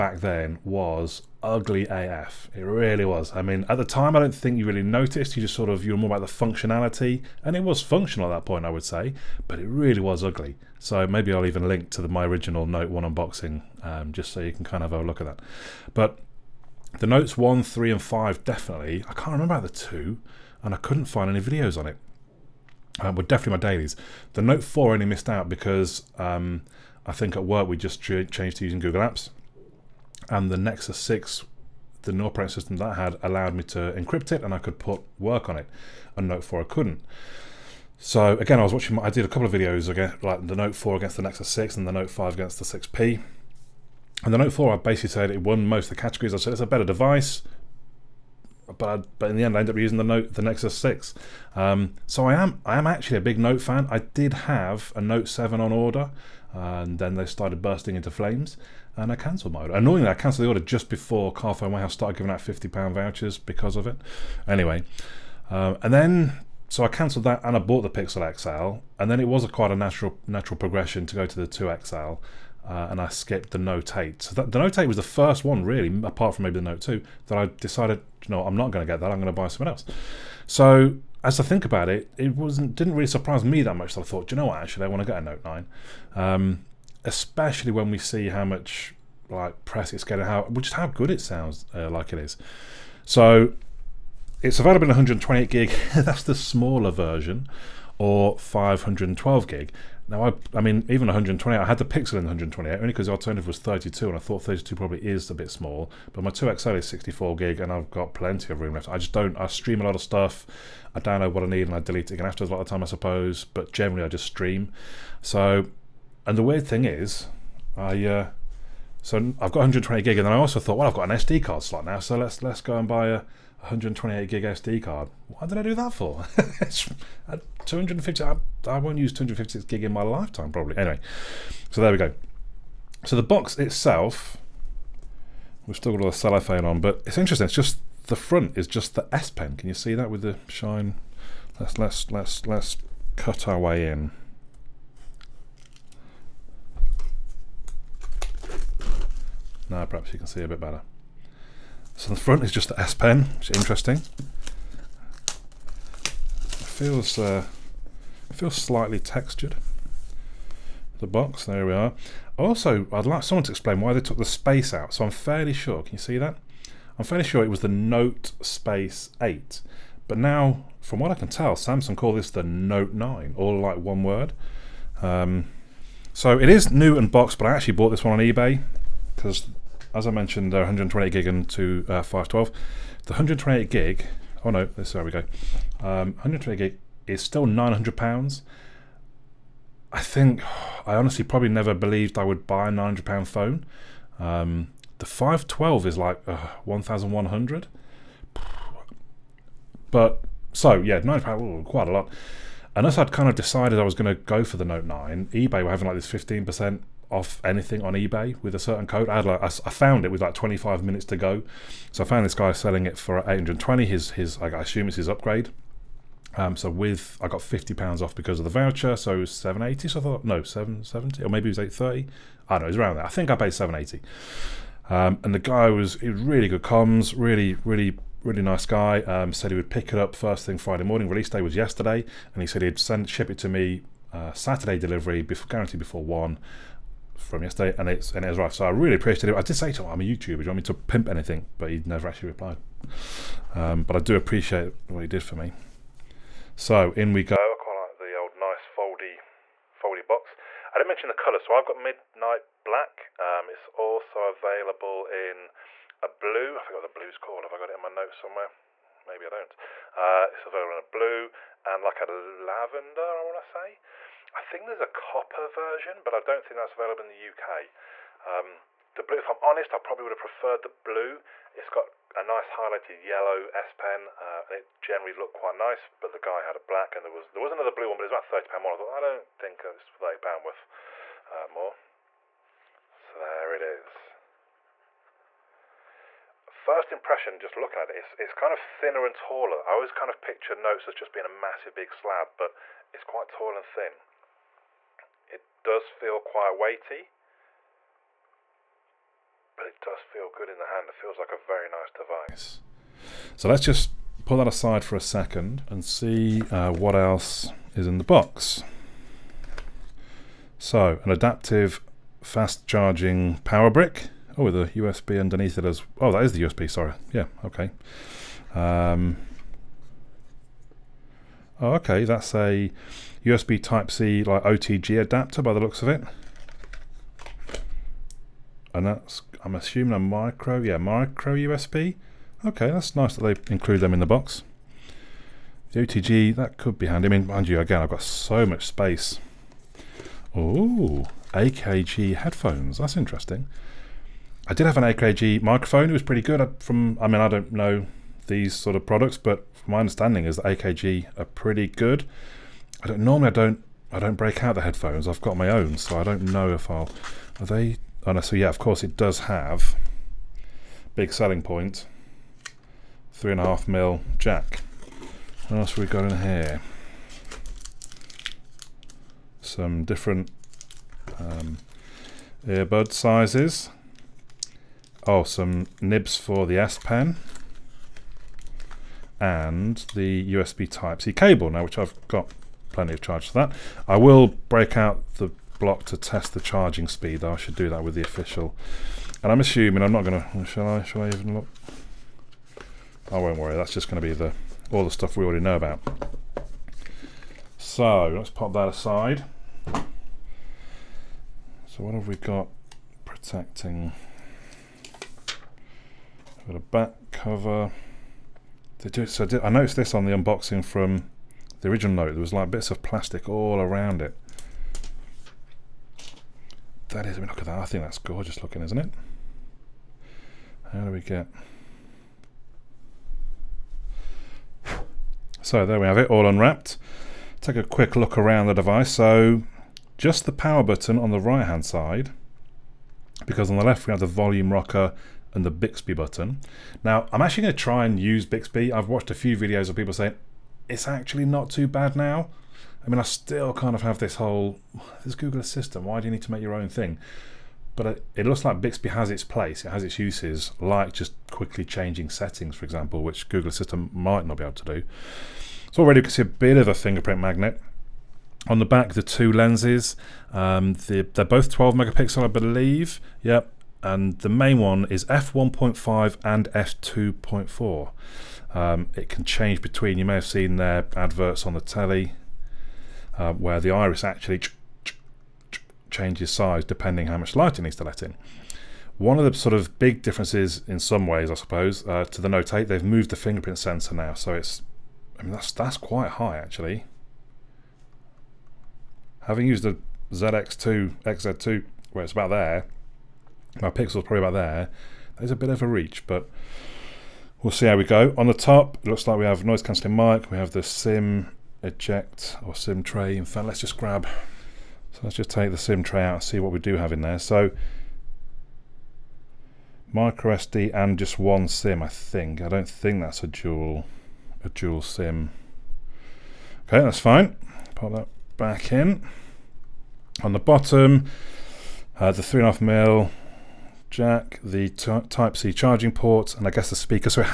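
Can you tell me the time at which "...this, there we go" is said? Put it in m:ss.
3:04.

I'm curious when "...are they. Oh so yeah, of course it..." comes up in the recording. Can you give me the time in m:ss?
5:57.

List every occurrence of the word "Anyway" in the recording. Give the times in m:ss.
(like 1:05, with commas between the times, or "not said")
1:04, 2:10.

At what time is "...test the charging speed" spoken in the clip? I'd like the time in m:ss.
6:25.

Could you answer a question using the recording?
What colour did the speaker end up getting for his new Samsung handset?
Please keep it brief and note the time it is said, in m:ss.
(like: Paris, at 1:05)
Midnight black, at 4:11.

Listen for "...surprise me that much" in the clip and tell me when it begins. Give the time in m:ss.
1:23.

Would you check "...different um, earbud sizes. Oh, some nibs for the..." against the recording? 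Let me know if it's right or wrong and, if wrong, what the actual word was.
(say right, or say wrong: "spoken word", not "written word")
right.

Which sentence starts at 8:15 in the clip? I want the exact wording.
That is a bit of a reach, but we'll see how we go.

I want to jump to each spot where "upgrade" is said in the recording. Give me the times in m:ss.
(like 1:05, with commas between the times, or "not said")
3:35.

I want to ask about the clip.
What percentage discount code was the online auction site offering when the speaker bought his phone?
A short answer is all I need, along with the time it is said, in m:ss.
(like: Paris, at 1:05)
15%, at 3:26.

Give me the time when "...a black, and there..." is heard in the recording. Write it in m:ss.
4:36.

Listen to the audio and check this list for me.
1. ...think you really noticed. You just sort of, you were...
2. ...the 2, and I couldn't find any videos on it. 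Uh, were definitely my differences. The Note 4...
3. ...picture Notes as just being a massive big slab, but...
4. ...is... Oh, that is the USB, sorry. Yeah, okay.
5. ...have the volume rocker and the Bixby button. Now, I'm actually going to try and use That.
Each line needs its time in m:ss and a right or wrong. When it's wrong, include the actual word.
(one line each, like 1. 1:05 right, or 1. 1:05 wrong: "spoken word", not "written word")
1. 0:04 right
2. 0:19 wrong: "dailies", not "differences"
3. 4:50 right
4. 5:15 right
5. 7:13 wrong: "Bixby", not "That".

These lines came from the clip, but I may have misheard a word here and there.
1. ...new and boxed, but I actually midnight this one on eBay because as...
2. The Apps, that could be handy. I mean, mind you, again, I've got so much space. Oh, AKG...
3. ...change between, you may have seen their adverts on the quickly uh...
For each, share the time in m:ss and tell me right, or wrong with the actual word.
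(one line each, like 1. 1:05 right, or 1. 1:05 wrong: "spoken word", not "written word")
1. 2:56 wrong: "bought", not "midnight"
2. 5:35 wrong: "OTG", not "Apps"
3. 7:49 wrong: "telly", not "quickly".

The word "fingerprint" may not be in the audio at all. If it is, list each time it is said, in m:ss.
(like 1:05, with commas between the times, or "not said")
7:36, 8:03.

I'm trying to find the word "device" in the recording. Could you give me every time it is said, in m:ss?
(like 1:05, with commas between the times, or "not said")
0:46, 5:01, 7:08.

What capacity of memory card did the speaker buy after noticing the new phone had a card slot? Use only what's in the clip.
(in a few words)
128 gig.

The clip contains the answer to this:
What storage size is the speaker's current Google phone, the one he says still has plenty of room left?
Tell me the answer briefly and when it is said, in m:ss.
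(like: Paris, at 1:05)
64 gig, at 1:46.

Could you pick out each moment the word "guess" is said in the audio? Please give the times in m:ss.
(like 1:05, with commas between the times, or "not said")
8:46.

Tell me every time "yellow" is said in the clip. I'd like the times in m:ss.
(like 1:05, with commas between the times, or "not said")
4:33.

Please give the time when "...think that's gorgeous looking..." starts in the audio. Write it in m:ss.
6:57.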